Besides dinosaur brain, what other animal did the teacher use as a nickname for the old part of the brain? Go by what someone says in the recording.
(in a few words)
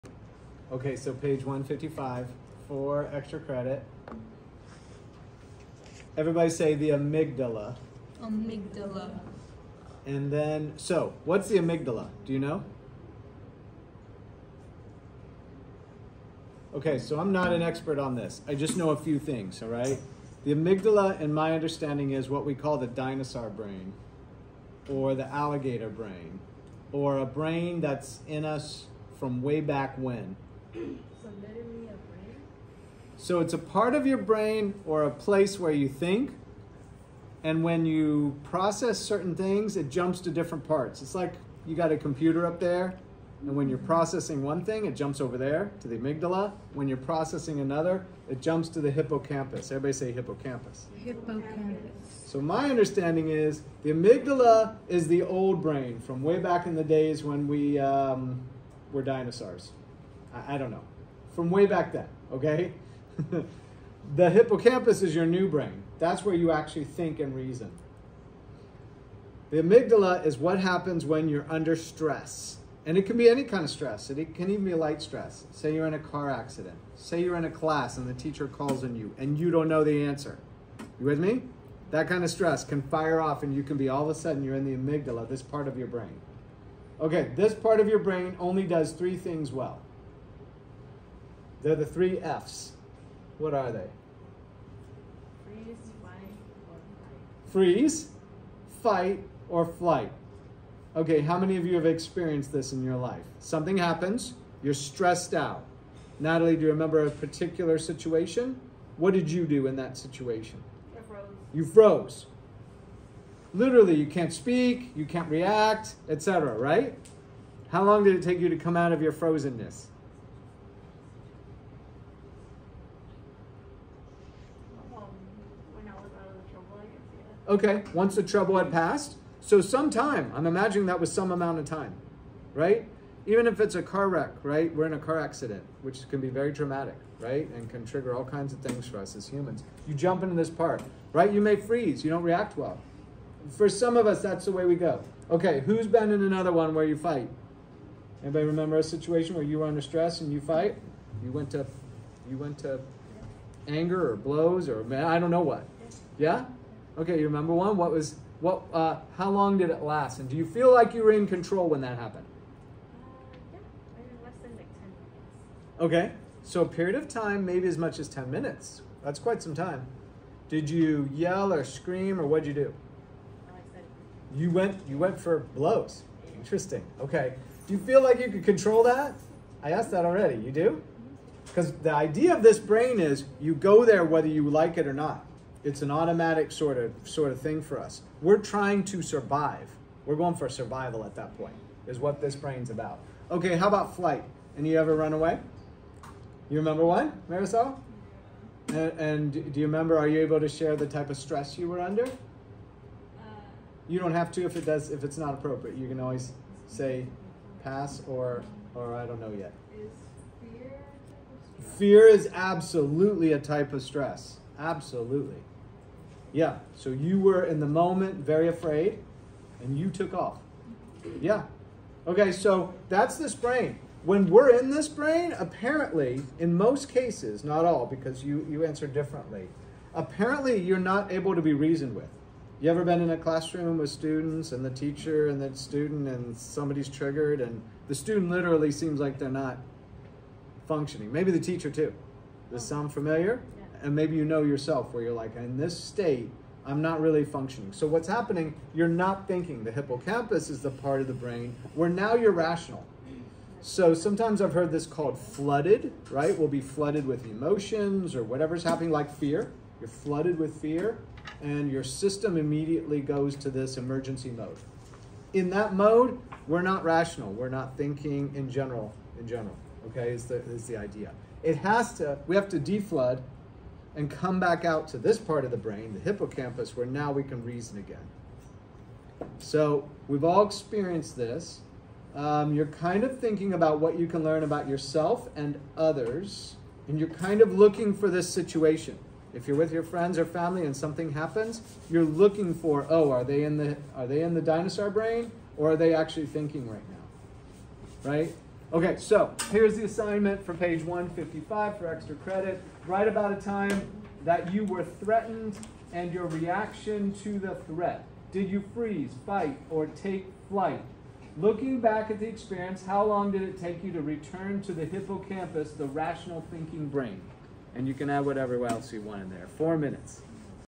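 Alligator.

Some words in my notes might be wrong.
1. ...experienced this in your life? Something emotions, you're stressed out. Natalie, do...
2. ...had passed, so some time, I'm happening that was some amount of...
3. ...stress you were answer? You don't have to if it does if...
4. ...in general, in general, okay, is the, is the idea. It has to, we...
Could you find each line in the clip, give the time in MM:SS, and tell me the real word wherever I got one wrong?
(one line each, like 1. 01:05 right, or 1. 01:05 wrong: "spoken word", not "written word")
1. 01:41 wrong: "happens", not "emotions"
2. 02:08 wrong: "imagining", not "happening"
3. 03:21 wrong: "under", not "answer"
4. 04:28 right.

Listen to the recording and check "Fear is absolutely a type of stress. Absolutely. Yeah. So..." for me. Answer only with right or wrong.
right.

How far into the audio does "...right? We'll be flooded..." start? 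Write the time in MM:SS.
04:16.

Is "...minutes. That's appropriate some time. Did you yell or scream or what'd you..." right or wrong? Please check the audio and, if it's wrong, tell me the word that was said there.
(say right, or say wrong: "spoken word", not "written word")
wrong: "quite", not "appropriate".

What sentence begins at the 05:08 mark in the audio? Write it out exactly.
Did you freeze, fight, or take flight?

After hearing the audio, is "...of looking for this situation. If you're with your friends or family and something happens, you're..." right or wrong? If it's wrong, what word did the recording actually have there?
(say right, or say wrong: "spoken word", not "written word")
right.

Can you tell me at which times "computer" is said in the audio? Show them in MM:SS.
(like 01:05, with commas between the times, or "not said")
00:41.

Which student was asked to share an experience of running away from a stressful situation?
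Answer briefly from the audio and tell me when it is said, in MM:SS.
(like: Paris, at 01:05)
Marisol, at 03:17.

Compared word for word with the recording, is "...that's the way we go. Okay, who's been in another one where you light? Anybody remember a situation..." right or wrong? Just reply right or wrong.
wrong.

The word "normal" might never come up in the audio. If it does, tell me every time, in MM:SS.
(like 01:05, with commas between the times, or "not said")
not said.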